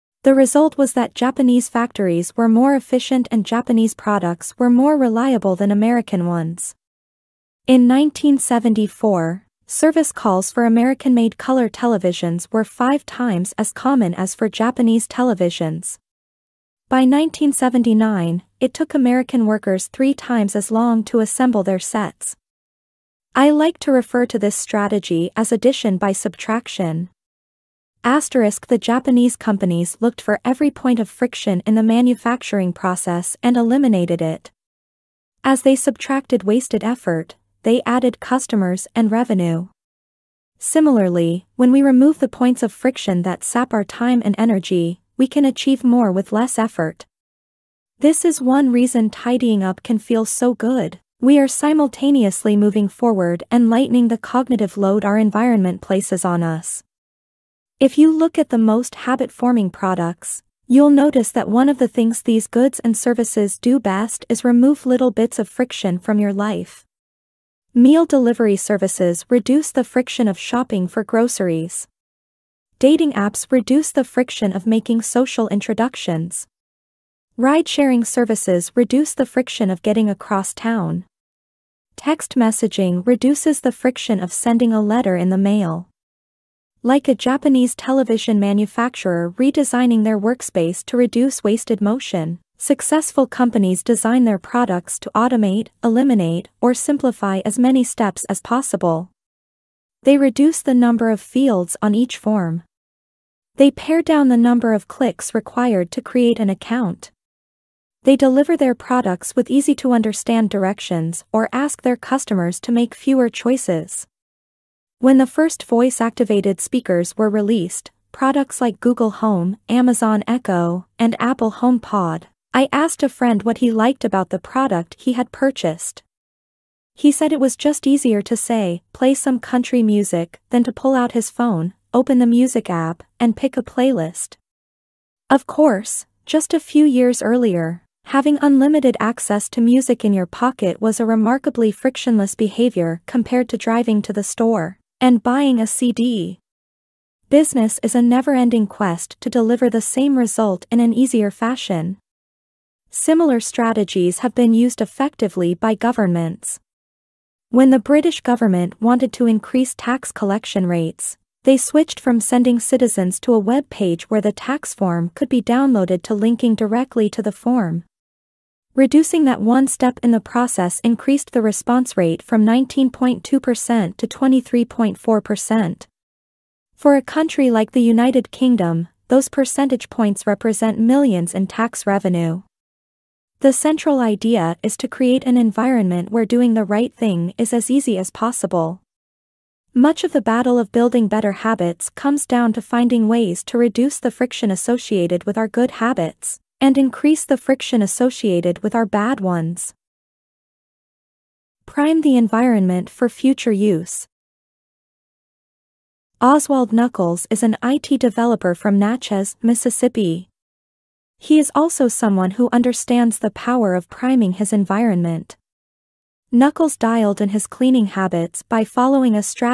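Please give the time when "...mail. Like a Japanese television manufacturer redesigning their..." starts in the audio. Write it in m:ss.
1:25.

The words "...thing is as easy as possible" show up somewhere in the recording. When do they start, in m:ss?
3:06.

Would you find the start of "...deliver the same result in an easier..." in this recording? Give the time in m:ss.
2:29.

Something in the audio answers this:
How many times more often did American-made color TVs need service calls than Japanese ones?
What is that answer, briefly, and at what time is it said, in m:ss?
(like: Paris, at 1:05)
5, at 0:12.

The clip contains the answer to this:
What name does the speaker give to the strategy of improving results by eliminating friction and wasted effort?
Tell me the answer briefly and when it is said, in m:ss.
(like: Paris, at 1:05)
addition by subtraction, at 0:25.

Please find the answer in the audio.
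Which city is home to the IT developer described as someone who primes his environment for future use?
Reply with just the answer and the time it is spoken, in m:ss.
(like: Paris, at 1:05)
Natchez, Mississippi, at 3:28.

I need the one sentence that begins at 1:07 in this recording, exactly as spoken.
Meal delivery services reduce the friction of shopping for groceries.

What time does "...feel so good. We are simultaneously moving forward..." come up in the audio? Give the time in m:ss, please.
0:49.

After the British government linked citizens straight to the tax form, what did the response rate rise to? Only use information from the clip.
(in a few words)
23.4%.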